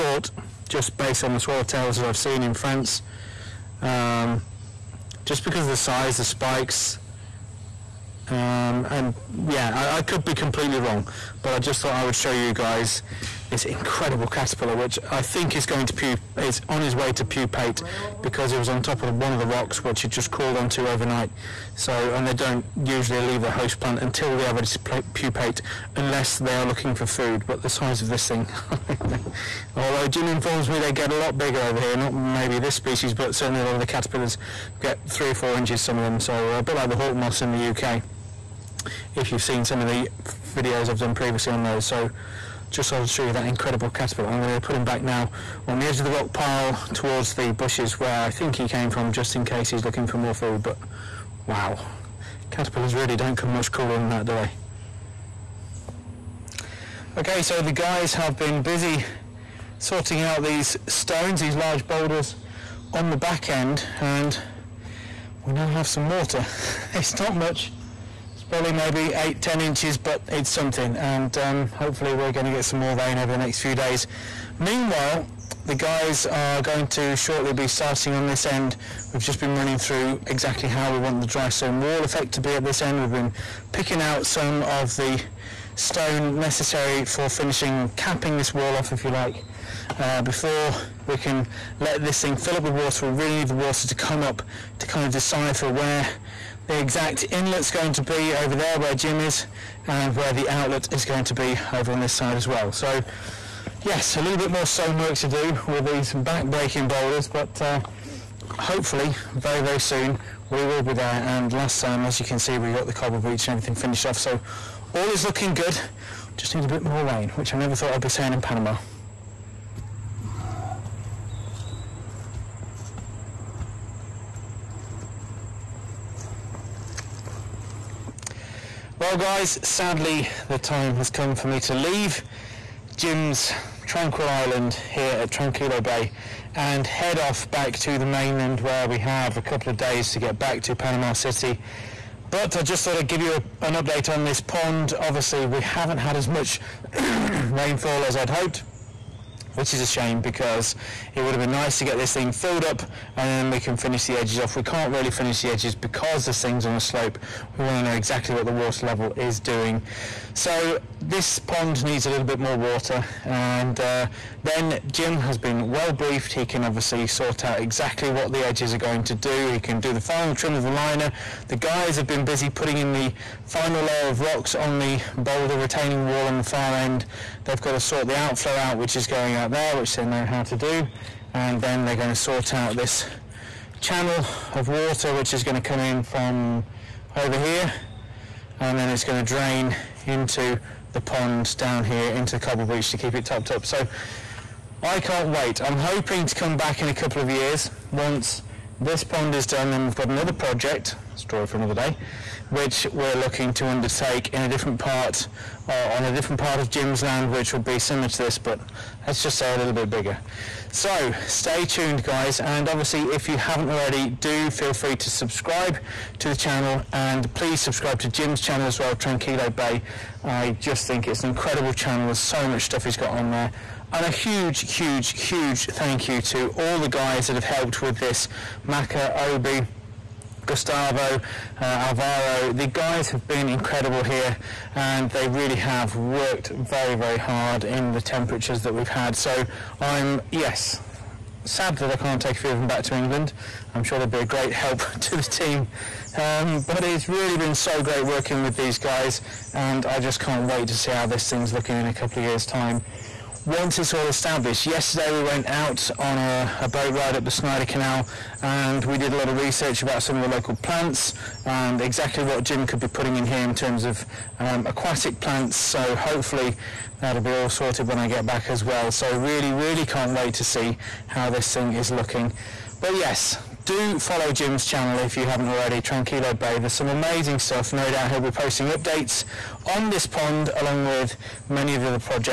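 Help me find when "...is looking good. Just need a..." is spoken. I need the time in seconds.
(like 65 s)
115 s.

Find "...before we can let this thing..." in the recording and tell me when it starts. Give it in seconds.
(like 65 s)
90 s.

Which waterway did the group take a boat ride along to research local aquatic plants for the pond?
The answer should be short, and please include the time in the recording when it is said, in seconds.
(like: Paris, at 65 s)
Snyder Canal, at 257 s.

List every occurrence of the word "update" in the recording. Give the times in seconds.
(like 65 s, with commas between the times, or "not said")
143 s, 278 s.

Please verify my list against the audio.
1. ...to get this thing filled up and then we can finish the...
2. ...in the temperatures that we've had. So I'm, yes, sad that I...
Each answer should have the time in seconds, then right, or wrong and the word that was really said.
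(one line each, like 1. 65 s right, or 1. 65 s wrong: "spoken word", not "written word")
1. 151 s right
2. 237 s right.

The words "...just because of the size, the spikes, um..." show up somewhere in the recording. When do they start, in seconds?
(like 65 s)
5 s.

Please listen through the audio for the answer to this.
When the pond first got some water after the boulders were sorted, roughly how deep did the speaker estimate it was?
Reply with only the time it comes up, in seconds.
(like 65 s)
69 s.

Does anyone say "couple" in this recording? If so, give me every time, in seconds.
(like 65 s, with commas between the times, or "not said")
139 s, 196 s, 251 s.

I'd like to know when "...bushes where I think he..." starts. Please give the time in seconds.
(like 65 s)
47 s.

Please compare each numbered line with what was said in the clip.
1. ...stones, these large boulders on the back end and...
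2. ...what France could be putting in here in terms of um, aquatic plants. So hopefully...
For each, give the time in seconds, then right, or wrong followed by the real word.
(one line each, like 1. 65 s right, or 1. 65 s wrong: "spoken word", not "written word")
1. 60 s right
2. 262 s wrong: "Jim", not "France".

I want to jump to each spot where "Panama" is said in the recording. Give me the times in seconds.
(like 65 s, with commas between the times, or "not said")
118 s, 140 s.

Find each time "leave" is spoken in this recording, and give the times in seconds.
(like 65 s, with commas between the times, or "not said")
23 s, 131 s.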